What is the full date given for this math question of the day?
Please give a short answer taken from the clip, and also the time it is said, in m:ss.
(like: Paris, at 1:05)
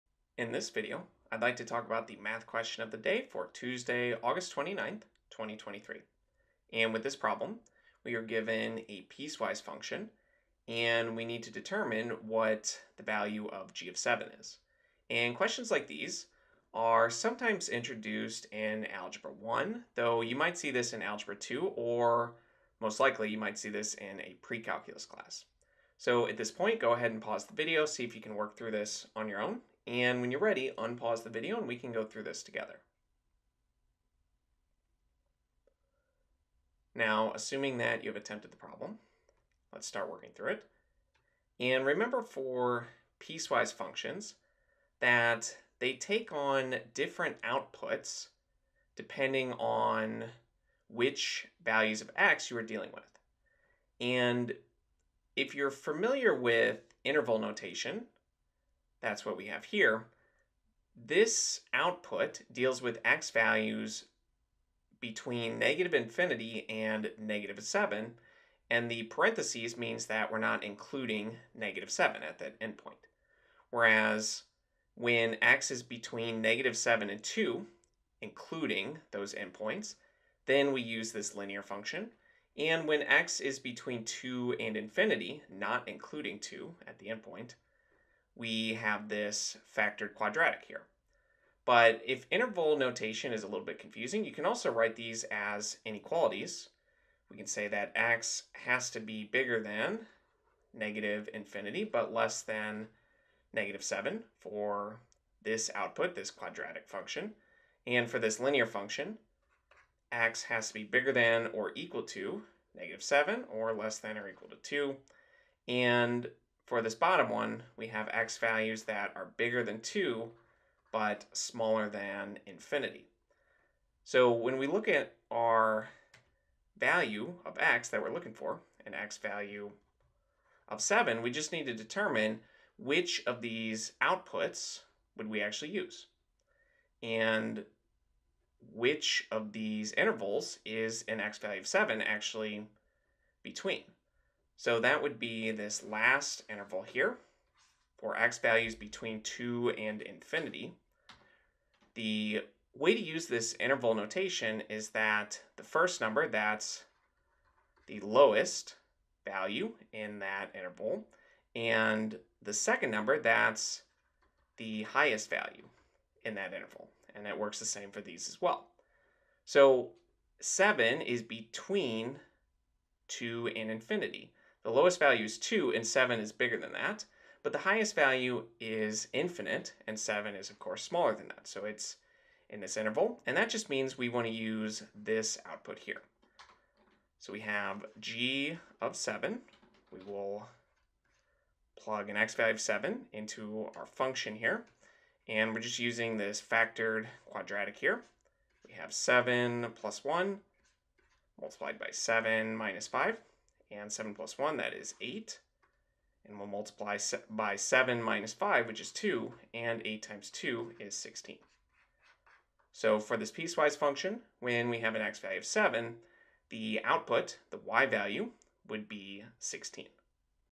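Tuesday, August 29th, 2023, at 0:03.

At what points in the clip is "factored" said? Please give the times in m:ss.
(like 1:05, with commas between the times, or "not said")
1:29, 3:16.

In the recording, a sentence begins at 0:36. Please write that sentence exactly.
Now, assuming that you've attempted the problem, let's start working through it.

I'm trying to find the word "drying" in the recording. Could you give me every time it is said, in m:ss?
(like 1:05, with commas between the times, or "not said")
not said.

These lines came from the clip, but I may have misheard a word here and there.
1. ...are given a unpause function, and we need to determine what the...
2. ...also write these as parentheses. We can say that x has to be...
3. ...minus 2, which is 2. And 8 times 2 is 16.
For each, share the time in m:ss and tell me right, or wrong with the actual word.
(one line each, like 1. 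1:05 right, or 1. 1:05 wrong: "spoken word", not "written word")
1. 0:08 wrong: "piecewise", not "unpause"
2. 1:34 wrong: "inequalities", not "parentheses"
3. 3:28 wrong: "5", not "2".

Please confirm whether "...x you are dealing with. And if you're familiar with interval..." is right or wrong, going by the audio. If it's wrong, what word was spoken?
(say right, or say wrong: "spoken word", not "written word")
right.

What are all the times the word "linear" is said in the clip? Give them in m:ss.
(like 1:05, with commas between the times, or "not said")
1:21, 1:48.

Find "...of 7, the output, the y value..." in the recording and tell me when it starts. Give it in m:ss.
3:35.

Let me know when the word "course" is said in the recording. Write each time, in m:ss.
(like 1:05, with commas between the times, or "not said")
3:00.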